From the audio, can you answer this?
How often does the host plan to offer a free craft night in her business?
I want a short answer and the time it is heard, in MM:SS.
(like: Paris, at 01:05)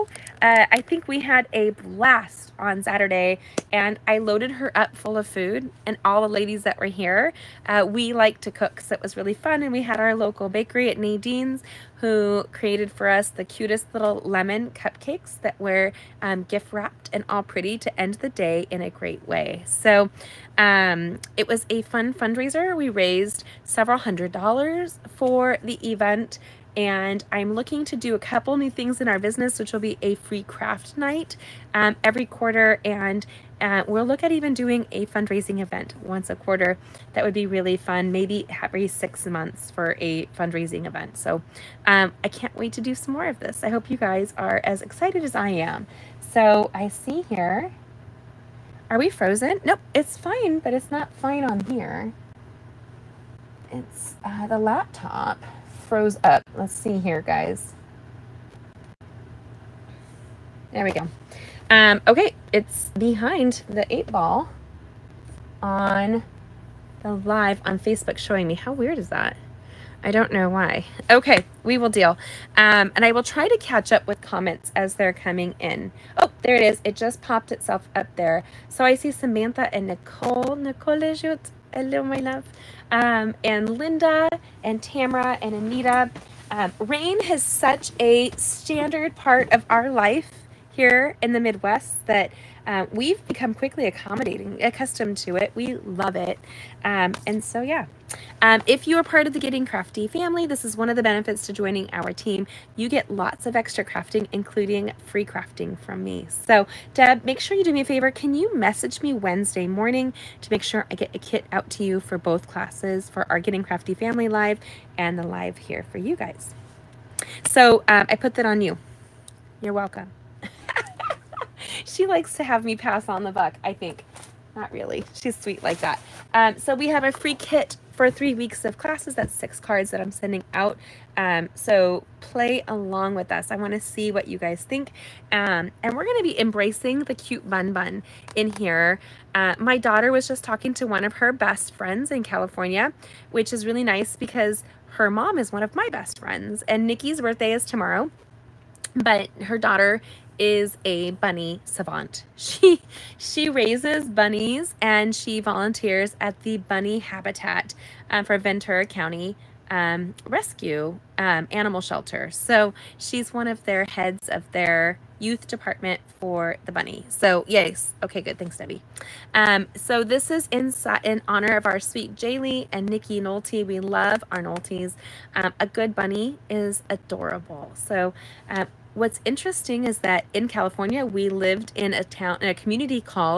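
every quarter, at 00:32.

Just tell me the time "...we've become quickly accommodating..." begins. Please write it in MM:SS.
01:32.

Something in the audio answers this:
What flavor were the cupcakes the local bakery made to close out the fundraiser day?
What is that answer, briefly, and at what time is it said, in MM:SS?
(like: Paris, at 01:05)
lemon, at 00:14.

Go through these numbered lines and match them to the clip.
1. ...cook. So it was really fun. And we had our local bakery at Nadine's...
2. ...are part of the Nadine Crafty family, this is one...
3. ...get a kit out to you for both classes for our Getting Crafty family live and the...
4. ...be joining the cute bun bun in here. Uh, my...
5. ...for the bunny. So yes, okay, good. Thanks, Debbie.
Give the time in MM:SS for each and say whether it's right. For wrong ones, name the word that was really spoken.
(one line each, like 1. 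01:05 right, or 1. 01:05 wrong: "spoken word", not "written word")
1. 00:08 right
2. 01:38 wrong: "Getting", not "Nadine"
3. 01:50 right
4. 02:16 wrong: "embracing", not "joining"
5. 02:46 right.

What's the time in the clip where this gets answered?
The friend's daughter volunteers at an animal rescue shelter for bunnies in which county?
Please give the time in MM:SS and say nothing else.
02:38.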